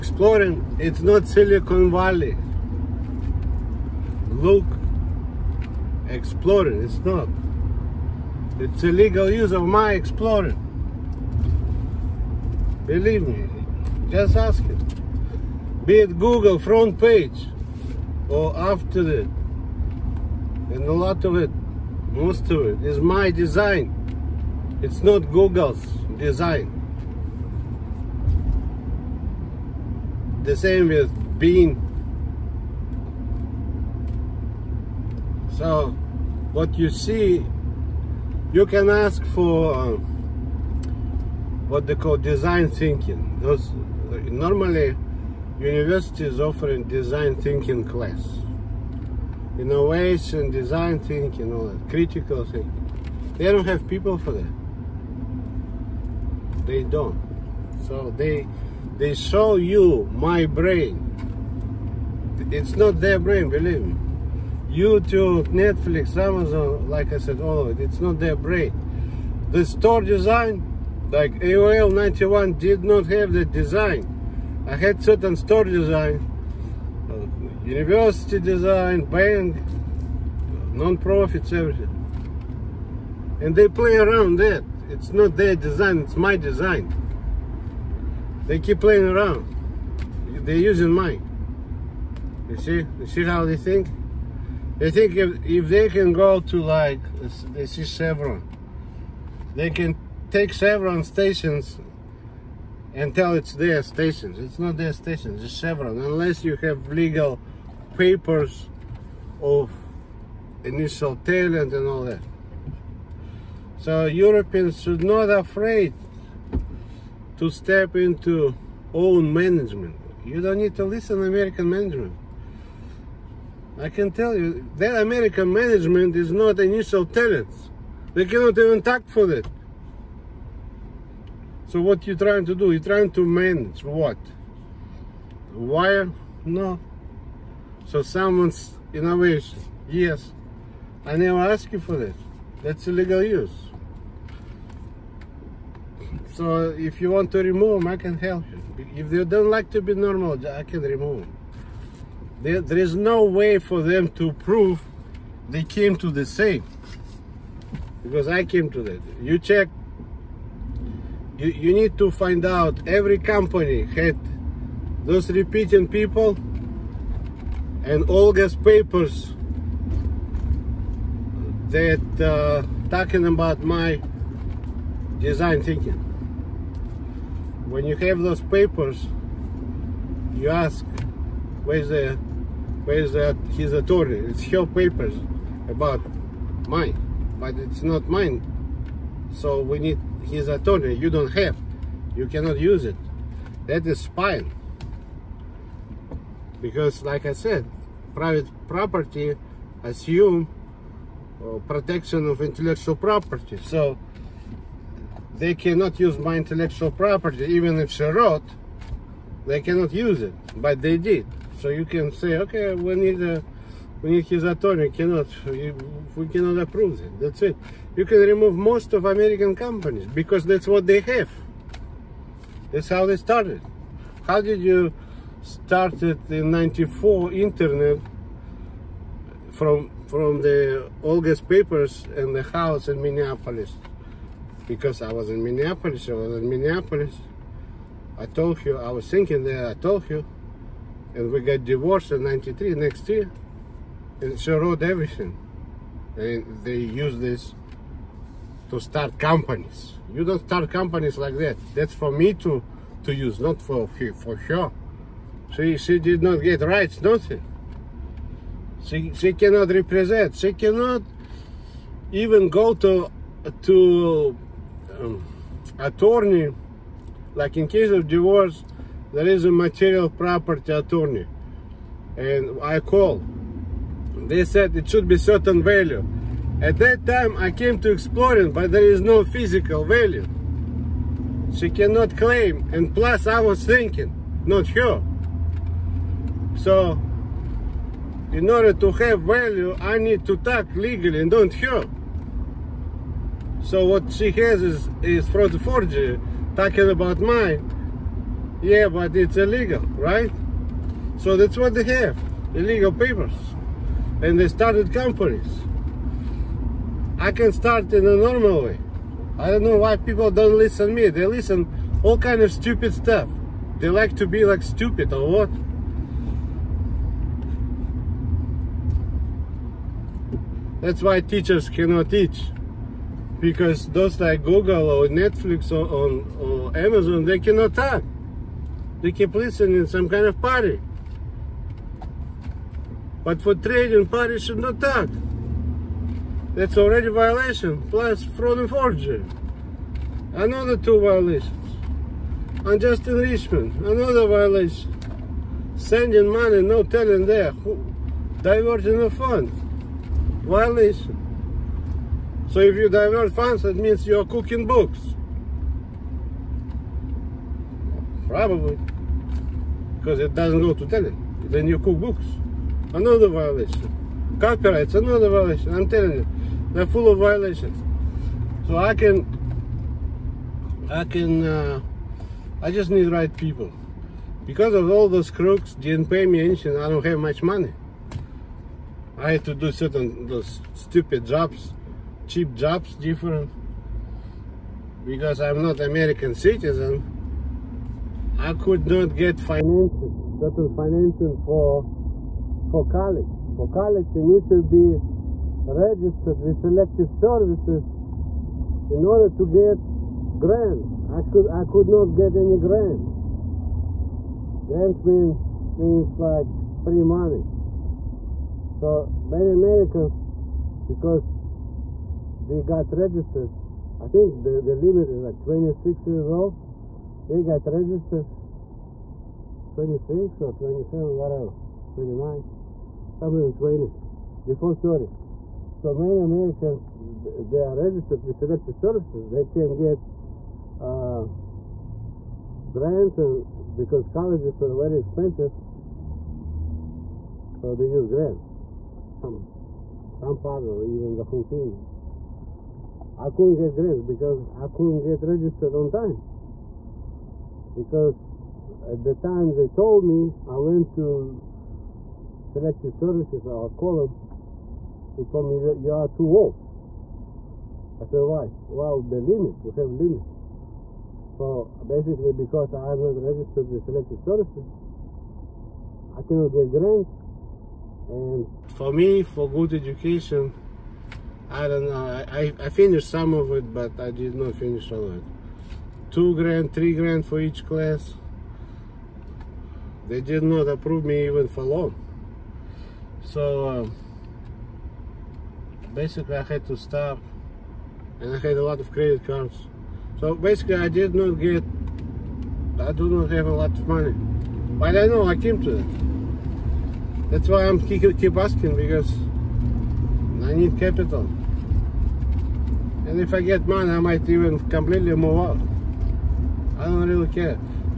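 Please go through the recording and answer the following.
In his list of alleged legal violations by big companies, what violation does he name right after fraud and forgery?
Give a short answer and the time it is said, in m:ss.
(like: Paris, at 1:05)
Unjust enrichment, at 5:42.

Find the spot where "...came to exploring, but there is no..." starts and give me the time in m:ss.
4:37.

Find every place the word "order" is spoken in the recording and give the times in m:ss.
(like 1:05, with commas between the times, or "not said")
4:48, 6:39.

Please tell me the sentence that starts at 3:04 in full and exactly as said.
It's her papers about mine, but it's not mine.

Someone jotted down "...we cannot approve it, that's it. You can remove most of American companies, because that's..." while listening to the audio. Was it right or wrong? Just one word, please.
right.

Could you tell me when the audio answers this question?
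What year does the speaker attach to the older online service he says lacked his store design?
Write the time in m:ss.
1:11.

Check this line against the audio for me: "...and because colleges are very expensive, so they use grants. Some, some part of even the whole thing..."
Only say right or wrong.
right.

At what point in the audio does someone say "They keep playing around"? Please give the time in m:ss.
1:28.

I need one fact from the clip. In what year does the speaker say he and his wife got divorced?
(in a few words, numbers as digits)
93.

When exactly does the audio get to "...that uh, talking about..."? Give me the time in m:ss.
2:51.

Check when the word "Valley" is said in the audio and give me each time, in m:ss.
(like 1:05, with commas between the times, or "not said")
0:01.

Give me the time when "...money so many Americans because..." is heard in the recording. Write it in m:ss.
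6:47.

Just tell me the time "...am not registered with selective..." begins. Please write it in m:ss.
7:42.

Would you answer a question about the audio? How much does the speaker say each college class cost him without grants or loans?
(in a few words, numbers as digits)
Two grand, three grand.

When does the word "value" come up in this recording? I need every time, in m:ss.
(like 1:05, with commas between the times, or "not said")
4:35, 4:39, 4:49.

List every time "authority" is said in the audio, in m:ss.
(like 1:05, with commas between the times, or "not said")
3:03, 3:10.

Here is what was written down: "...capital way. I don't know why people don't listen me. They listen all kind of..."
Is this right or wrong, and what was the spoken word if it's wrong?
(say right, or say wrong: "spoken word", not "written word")
wrong: "normal", not "capital".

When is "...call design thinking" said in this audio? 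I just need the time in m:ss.
0:41.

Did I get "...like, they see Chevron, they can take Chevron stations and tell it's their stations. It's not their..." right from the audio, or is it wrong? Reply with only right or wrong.
right.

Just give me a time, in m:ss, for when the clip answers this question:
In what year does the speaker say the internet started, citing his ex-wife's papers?
3:46.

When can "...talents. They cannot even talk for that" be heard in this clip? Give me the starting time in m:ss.
2:07.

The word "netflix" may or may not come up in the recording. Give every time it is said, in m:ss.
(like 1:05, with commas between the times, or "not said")
1:05, 5:25.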